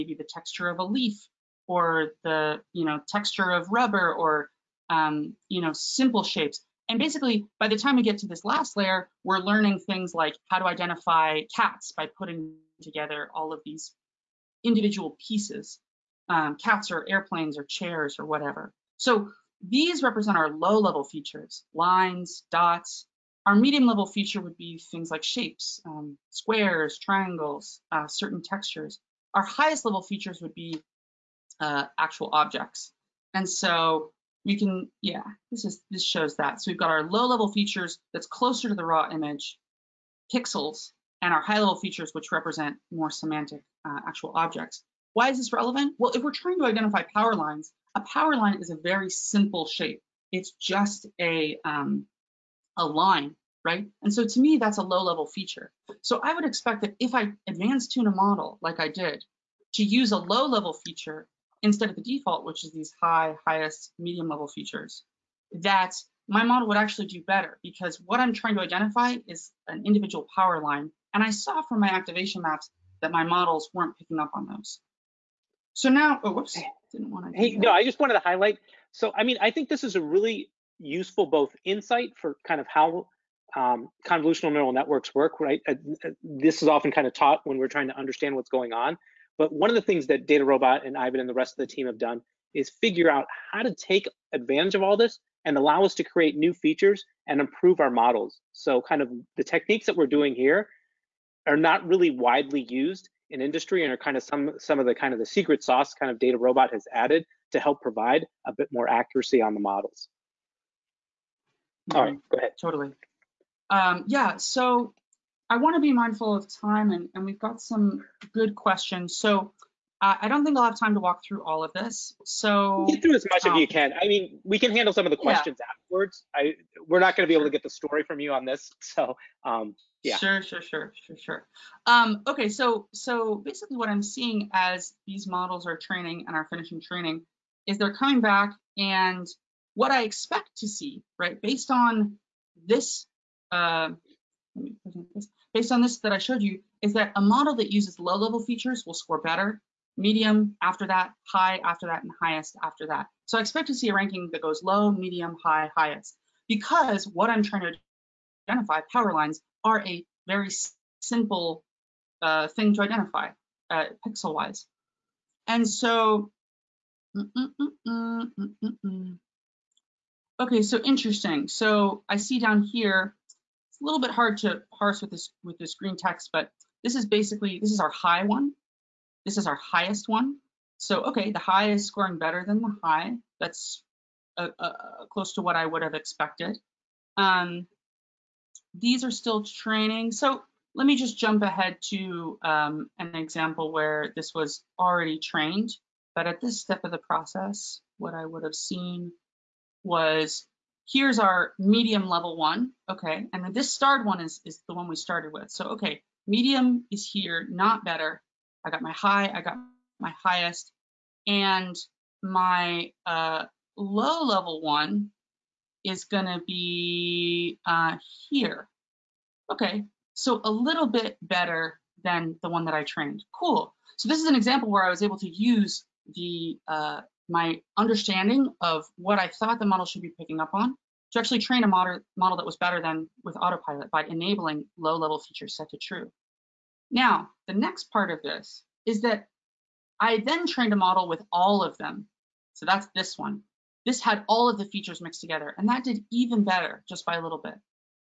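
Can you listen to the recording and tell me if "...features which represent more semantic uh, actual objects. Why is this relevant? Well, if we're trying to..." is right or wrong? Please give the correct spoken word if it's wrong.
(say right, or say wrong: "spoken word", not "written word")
right.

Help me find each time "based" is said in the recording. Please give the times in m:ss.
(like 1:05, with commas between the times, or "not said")
2:21, 2:25.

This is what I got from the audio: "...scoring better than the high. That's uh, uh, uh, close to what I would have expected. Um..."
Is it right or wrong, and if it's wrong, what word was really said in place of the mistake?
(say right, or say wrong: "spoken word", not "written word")
right.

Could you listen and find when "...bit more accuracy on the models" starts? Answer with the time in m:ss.
1:48.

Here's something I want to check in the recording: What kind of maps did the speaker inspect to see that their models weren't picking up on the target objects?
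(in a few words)
Activation maps.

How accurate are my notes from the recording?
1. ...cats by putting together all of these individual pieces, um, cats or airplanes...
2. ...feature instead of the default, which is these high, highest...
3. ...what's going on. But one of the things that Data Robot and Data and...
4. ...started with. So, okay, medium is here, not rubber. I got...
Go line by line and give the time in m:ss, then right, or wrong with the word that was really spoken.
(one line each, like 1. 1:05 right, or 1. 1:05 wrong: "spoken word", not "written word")
1. 0:11 right
2. 1:00 right
3. 1:28 wrong: "Ivan", not "Data"
4. 3:24 wrong: "better", not "rubber".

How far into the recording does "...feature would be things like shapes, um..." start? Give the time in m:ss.
0:24.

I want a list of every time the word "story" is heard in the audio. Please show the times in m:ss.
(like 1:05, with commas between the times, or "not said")
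2:07.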